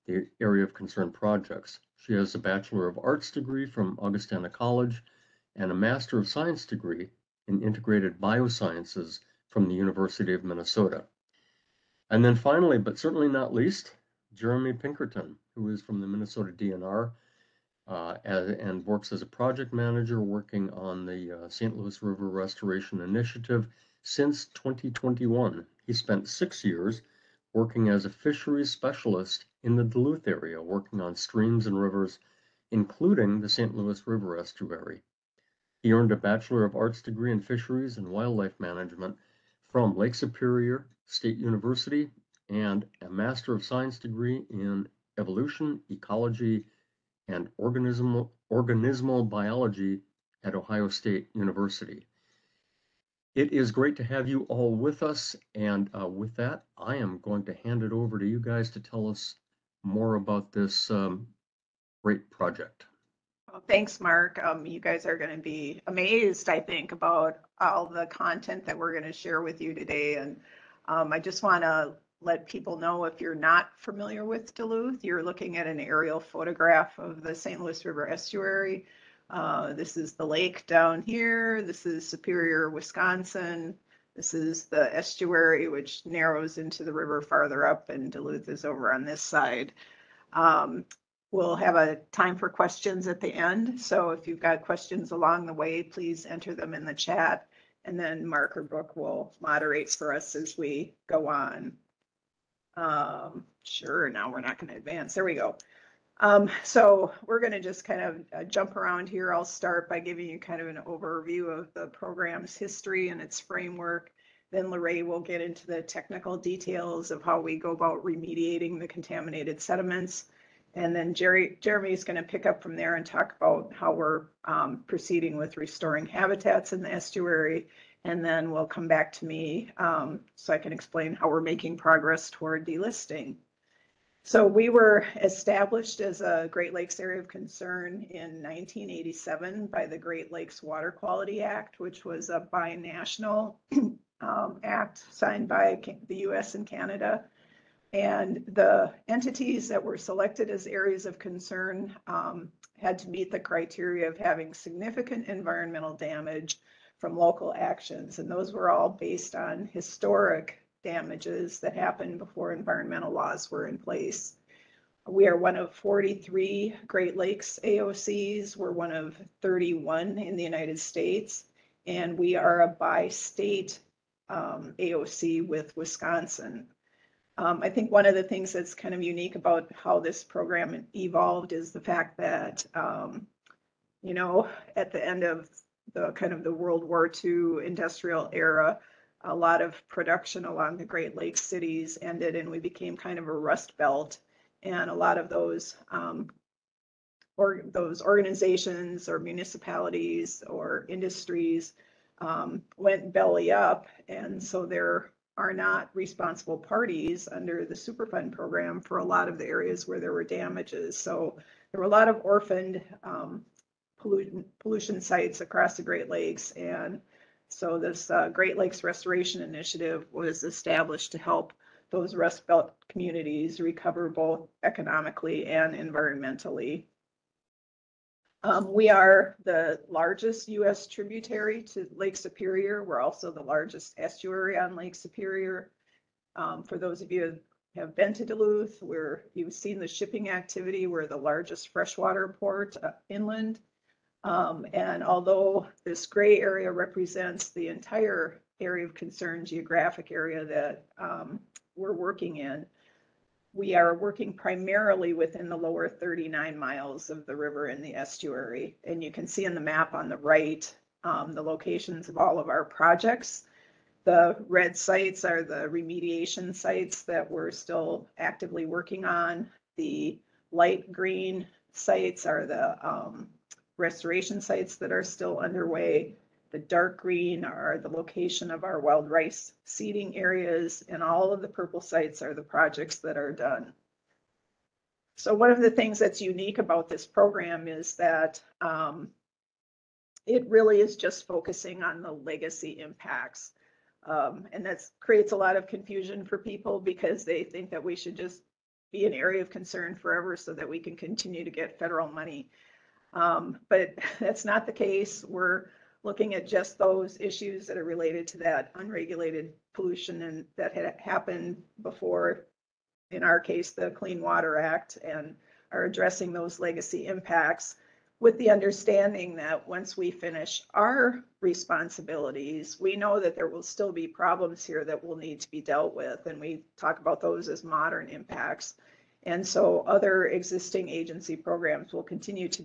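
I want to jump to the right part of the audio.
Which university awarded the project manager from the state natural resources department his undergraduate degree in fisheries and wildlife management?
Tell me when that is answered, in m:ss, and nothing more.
0:39.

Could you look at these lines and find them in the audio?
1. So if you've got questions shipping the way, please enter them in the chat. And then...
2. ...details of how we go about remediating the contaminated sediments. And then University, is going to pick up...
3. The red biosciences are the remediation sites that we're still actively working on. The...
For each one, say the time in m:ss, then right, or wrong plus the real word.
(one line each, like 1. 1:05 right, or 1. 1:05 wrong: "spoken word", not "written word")
1. 1:33 wrong: "along", not "shipping"
2. 1:56 wrong: "Jerry", not "University"
3. 4:24 wrong: "sites", not "biosciences".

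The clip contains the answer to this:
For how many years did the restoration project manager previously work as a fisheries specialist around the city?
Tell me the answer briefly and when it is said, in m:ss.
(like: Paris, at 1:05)
6, at 0:26.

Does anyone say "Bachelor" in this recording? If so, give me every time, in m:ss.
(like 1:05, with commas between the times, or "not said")
0:02, 0:36.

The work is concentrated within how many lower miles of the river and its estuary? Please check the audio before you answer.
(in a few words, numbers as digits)
39.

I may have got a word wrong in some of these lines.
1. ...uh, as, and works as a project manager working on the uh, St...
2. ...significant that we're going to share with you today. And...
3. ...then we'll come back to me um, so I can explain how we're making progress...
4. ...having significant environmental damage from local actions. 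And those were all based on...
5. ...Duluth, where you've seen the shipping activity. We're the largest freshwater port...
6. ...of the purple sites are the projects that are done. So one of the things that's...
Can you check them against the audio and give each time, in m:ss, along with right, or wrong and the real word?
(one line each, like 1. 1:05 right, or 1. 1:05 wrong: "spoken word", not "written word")
1. 0:17 right
2. 1:08 wrong: "content", not "significant"
3. 2:08 right
4. 2:34 right
5. 3:58 right
6. 4:41 right.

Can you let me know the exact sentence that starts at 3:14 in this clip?
And a lot of those um, or those organizations or municipalities or industries um, went belly up.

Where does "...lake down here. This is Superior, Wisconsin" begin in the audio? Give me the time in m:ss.
1:20.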